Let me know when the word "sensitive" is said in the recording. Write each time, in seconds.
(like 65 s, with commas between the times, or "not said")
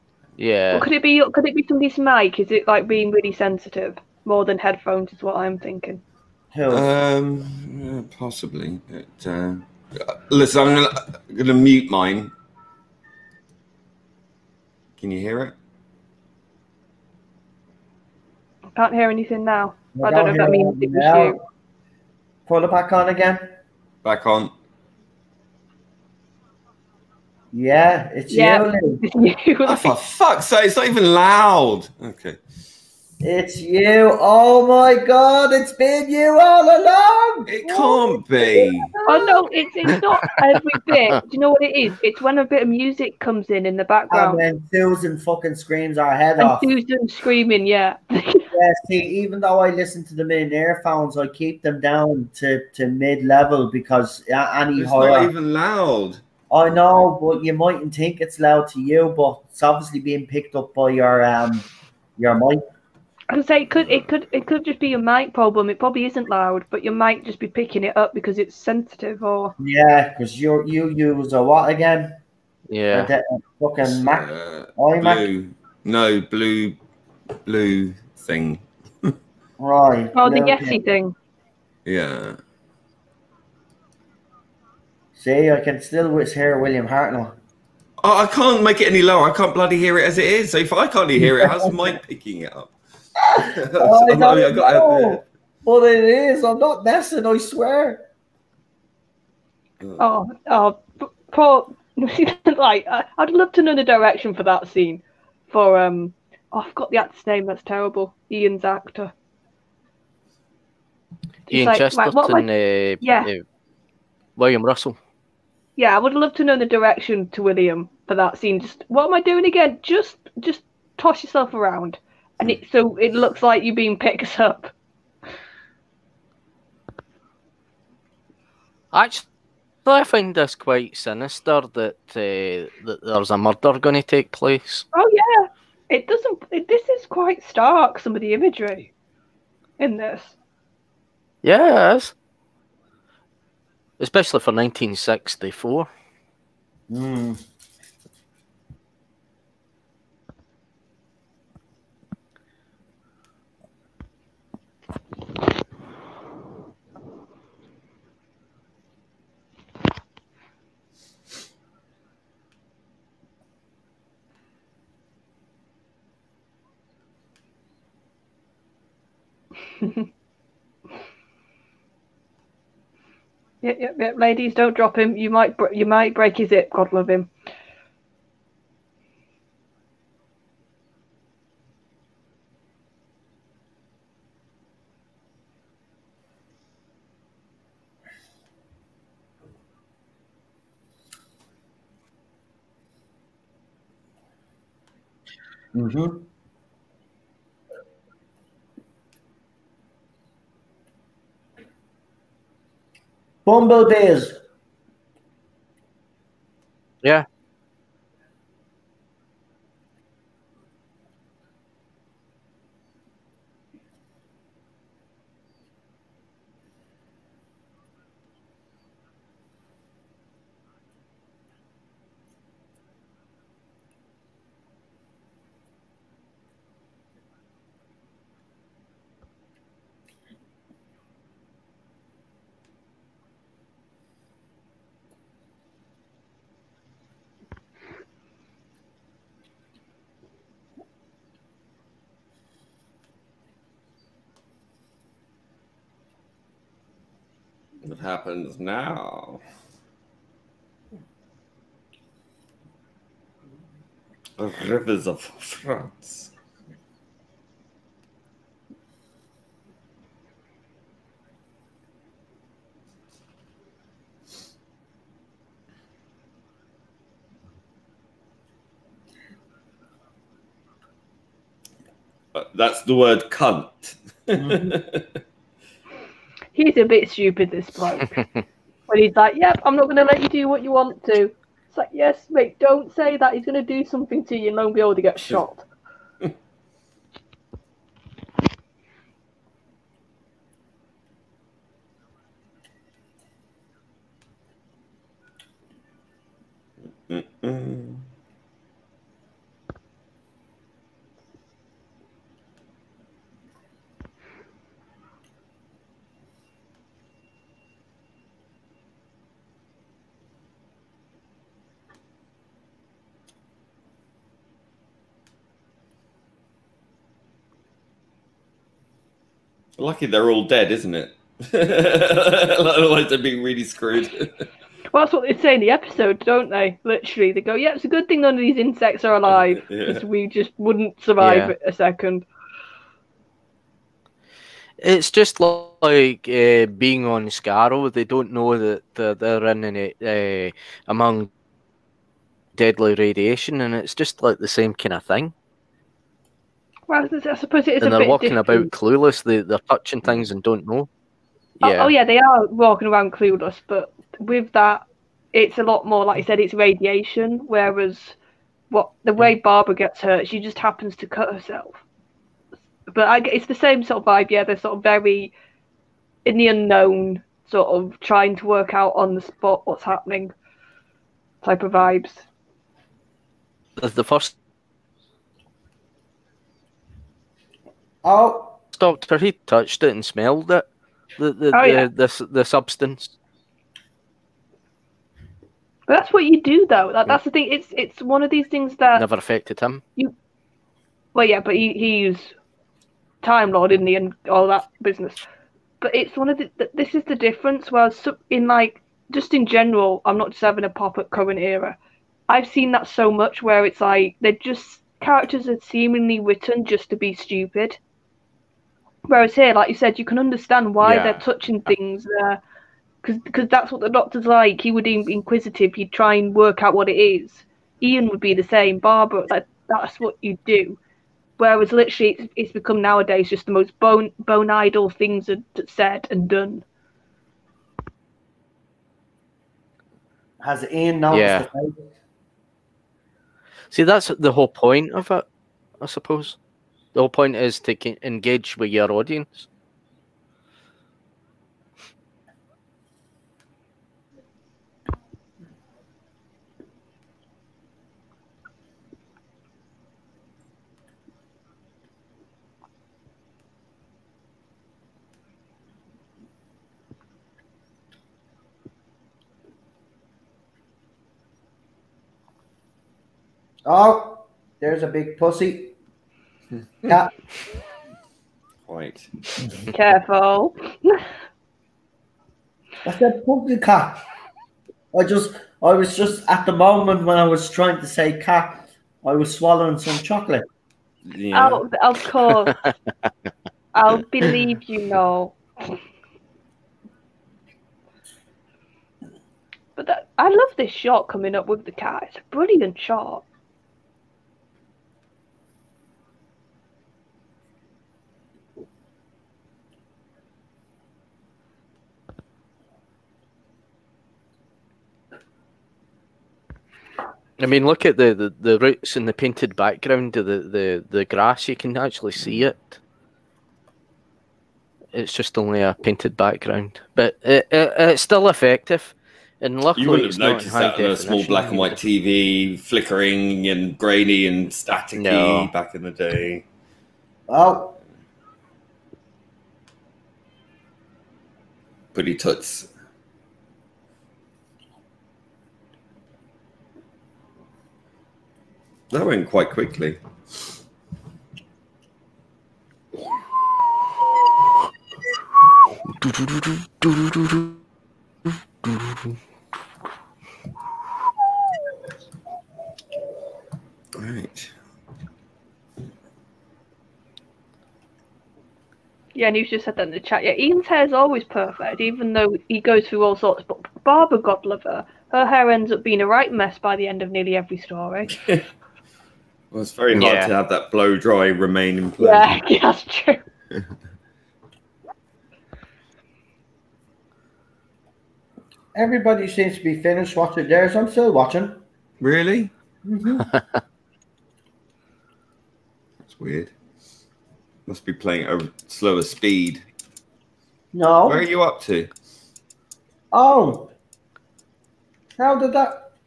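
3 s, 68 s.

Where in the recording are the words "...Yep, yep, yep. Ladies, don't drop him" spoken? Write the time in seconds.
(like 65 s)
173 s.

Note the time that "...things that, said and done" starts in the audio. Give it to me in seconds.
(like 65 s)
424 s.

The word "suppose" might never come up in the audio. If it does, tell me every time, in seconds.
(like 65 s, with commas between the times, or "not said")
347 s, 435 s.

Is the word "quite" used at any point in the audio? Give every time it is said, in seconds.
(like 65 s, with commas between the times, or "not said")
130 s, 137 s, 539 s.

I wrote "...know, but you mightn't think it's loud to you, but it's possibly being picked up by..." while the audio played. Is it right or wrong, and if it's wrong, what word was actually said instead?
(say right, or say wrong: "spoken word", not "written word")
wrong: "obviously", not "possibly".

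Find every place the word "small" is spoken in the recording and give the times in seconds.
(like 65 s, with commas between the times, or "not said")
520 s.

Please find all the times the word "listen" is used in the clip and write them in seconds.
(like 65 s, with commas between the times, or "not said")
10 s, 49 s.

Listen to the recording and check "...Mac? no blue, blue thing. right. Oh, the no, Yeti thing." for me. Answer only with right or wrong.
right.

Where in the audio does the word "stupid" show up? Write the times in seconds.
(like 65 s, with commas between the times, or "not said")
277 s, 407 s.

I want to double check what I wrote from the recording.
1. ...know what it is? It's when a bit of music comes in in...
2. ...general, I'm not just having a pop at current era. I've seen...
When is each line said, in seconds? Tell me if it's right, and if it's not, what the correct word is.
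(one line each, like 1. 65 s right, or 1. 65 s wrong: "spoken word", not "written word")
1. 41 s right
2. 399 s right.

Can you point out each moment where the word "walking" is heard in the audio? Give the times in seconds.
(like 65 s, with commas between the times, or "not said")
348 s, 352 s.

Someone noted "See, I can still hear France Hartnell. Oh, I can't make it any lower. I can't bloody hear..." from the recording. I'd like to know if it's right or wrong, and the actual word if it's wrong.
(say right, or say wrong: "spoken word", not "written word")
wrong: "William", not "France".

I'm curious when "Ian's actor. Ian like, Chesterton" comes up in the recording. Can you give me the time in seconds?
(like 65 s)
108 s.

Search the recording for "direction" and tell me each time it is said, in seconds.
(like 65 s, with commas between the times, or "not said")
103 s, 116 s.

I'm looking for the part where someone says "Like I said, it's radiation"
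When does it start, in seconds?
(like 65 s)
356 s.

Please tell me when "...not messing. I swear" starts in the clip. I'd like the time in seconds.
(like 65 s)
96 s.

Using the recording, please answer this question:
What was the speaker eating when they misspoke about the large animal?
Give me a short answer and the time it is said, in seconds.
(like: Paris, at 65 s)
chocolate, at 479 s.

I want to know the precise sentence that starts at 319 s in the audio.
Lucky they're all dead, isn't it?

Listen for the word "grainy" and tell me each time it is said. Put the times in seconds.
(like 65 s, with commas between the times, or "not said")
523 s.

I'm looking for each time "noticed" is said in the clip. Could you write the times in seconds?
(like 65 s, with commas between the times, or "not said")
430 s, 520 s.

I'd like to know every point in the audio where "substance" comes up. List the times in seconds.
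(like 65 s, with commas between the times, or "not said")
382 s.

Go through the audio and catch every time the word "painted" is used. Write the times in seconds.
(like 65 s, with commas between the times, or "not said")
509 s, 515 s.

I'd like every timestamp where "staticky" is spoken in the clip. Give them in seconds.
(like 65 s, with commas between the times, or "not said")
524 s.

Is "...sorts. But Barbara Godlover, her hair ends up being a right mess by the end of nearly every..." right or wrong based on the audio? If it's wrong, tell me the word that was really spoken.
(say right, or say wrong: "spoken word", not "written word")
right.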